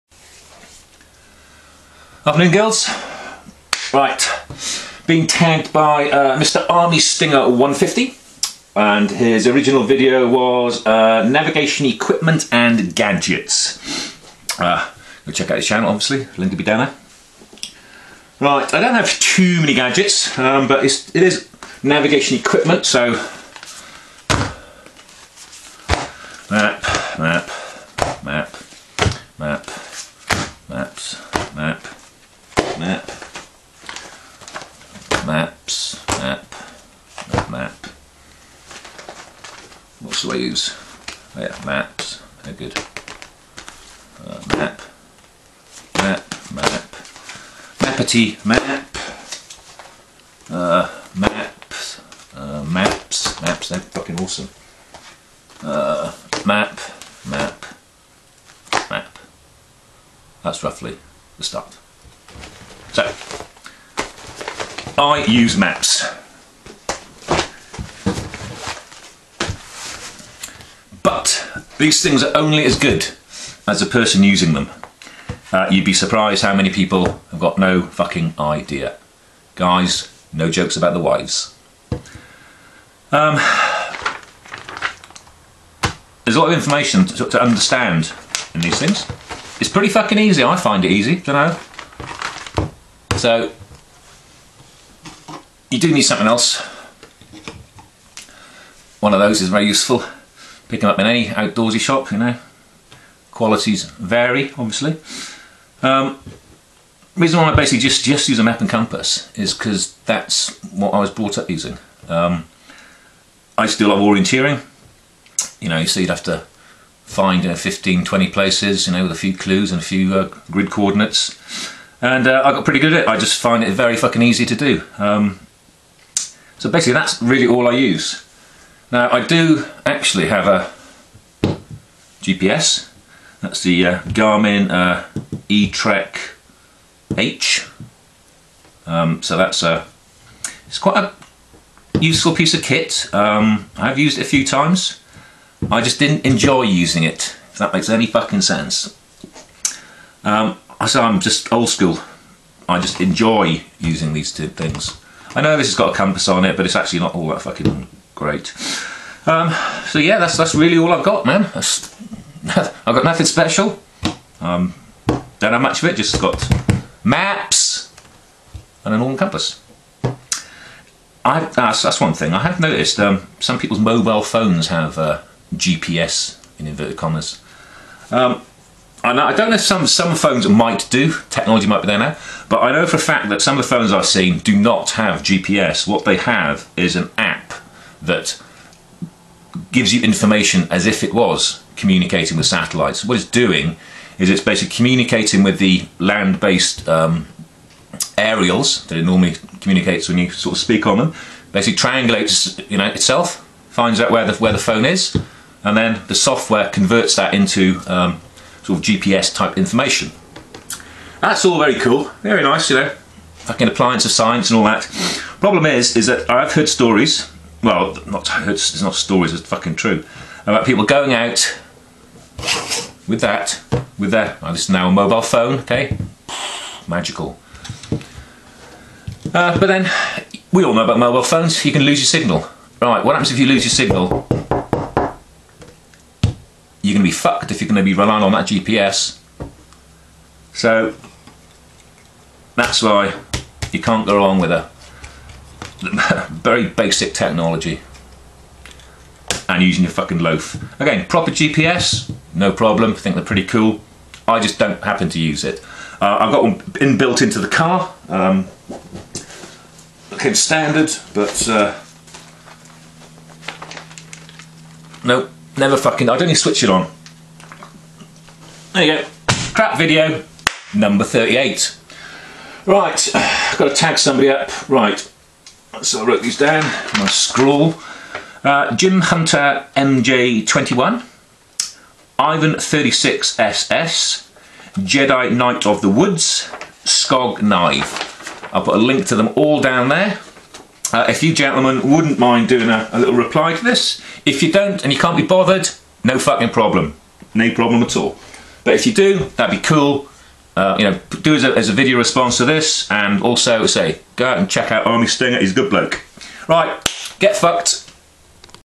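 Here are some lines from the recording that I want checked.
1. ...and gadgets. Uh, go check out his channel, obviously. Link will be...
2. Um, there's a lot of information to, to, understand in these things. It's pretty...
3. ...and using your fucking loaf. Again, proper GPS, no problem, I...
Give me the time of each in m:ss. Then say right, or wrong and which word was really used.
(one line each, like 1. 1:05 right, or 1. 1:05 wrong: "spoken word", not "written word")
1. 0:12 right
2. 1:23 right
3. 4:09 right.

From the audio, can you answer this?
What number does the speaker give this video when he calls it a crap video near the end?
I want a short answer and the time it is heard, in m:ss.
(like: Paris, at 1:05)
38, at 4:30.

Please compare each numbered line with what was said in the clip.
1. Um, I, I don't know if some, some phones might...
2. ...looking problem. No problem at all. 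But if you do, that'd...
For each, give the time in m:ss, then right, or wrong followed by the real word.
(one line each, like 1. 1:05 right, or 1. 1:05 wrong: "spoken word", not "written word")
1. 2:58 right
2. 4:56 wrong: "fucking", not "looking".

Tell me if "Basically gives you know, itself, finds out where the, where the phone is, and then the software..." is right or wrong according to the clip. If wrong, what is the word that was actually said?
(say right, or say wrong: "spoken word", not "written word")
wrong: "triangulates", not "gives".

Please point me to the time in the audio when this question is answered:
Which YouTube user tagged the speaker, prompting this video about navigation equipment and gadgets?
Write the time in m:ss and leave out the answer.
0:06.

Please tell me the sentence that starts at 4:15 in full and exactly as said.
Uh, I've got one inbuilt into the car, um, looking standard, but uh, nope, never fucking, I don't even switch it on.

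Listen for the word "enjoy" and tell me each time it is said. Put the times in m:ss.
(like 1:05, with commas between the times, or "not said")
2:26, 2:32.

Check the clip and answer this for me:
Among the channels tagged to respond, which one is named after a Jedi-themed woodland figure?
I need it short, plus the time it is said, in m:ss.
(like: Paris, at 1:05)
Jedi Knight of the Woods, at 4:44.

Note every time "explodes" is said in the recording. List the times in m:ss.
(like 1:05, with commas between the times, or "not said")
not said.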